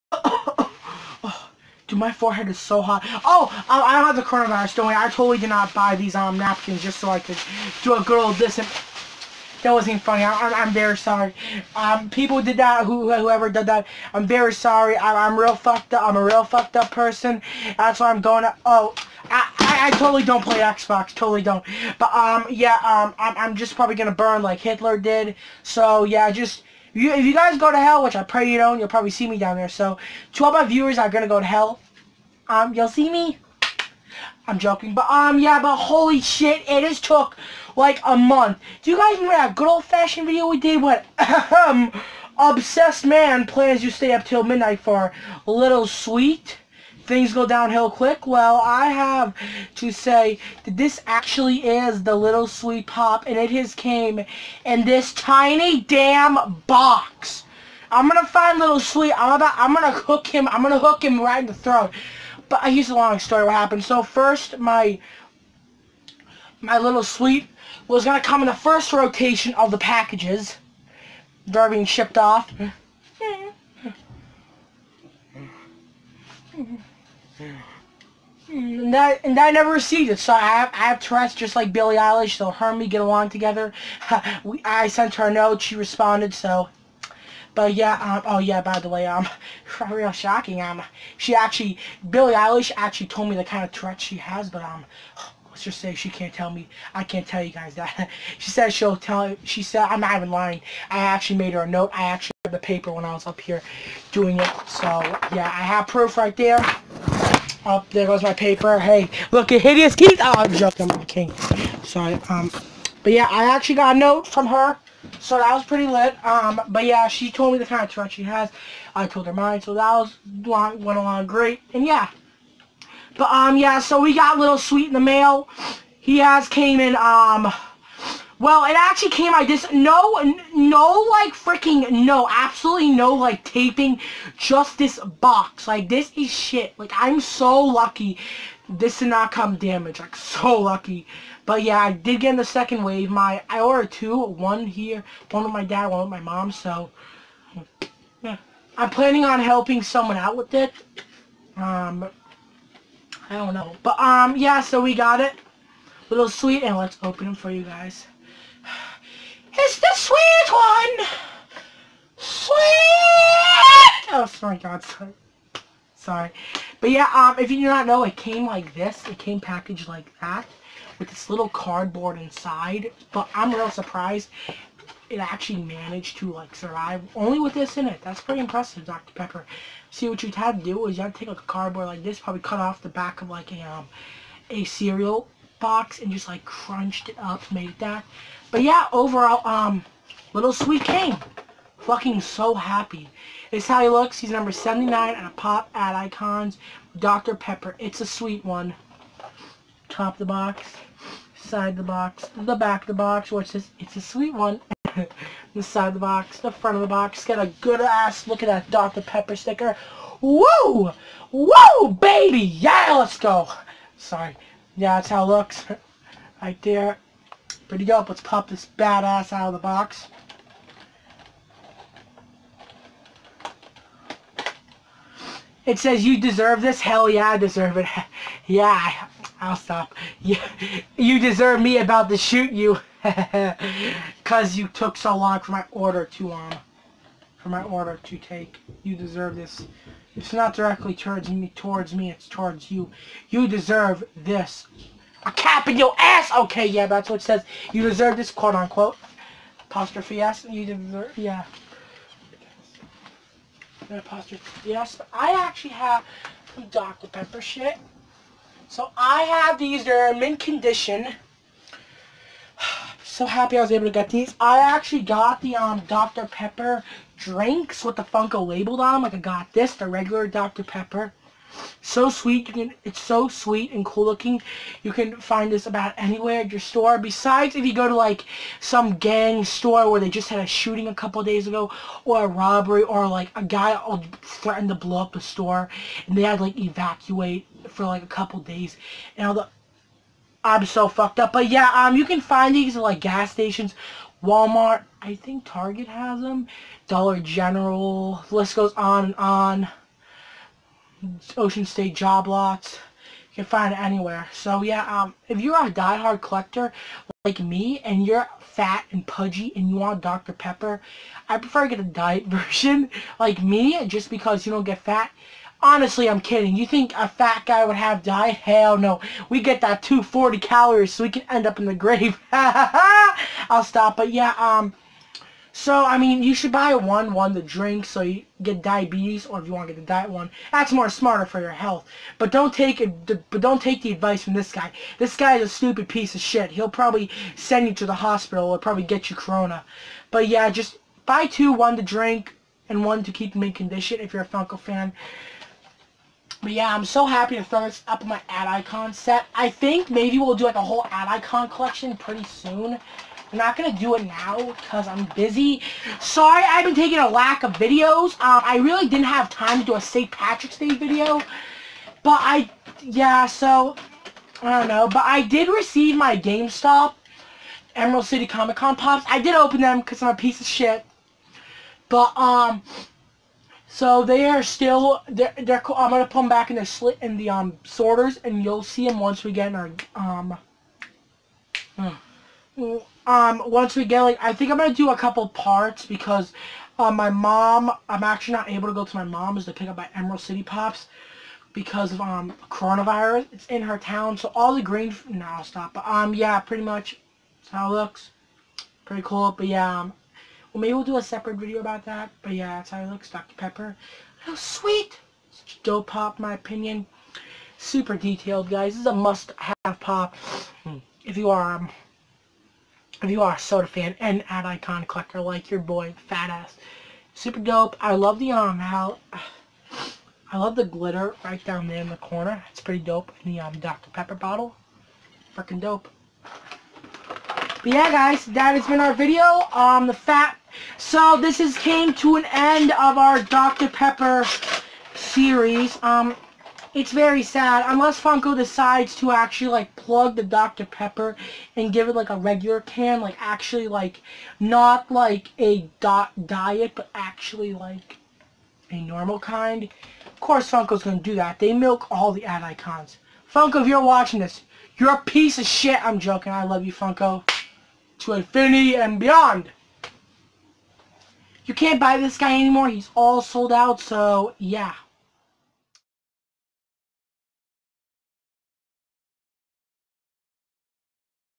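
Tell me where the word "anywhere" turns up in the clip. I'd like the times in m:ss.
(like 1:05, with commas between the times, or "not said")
4:35, 5:03.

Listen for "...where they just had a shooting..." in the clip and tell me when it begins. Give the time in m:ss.
4:39.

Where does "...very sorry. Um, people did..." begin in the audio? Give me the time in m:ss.
0:10.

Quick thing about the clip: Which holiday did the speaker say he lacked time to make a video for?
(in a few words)
St. Patrick's Day.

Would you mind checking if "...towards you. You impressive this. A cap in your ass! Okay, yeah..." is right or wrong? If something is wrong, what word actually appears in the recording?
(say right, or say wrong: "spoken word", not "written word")
wrong: "deserve", not "impressive".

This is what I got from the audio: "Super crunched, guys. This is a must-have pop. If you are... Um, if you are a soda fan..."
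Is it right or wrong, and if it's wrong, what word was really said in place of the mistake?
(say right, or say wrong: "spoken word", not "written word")
wrong: "detailed", not "crunched".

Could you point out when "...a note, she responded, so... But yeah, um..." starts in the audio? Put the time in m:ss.
1:25.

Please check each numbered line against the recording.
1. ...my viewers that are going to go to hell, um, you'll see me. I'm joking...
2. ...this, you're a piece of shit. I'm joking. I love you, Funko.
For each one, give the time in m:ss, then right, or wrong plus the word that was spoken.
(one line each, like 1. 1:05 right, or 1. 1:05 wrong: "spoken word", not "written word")
1. 0:30 right
2. 7:34 right.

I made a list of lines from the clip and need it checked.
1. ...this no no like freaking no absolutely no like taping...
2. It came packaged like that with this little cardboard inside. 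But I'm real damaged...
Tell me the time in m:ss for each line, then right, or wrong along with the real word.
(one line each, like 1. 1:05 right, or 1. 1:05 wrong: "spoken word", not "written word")
1. 2:09 right
2. 2:49 wrong: "surprised", not "damaged".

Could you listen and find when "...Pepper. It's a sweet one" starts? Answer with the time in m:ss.
3:17.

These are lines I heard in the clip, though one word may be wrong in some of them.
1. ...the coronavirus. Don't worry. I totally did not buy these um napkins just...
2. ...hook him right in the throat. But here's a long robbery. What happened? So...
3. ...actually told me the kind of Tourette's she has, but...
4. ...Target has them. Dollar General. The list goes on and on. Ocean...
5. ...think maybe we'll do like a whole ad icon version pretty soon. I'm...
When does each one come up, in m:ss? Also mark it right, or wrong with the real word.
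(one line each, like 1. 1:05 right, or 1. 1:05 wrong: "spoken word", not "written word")
1. 0:04 right
2. 1:00 wrong: "story", not "robbery"
3. 1:32 right
4. 4:55 right
5. 5:49 wrong: "collection", not "version".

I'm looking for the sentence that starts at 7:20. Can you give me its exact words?
Pepper and give it, like, a regular can.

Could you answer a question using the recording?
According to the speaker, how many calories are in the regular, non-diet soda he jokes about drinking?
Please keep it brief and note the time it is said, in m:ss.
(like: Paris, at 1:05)
240, at 5:19.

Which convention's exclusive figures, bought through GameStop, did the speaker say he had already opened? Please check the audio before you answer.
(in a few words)
Emerald City Comic Con.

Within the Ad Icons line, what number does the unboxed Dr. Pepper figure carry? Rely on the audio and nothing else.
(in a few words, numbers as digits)
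79.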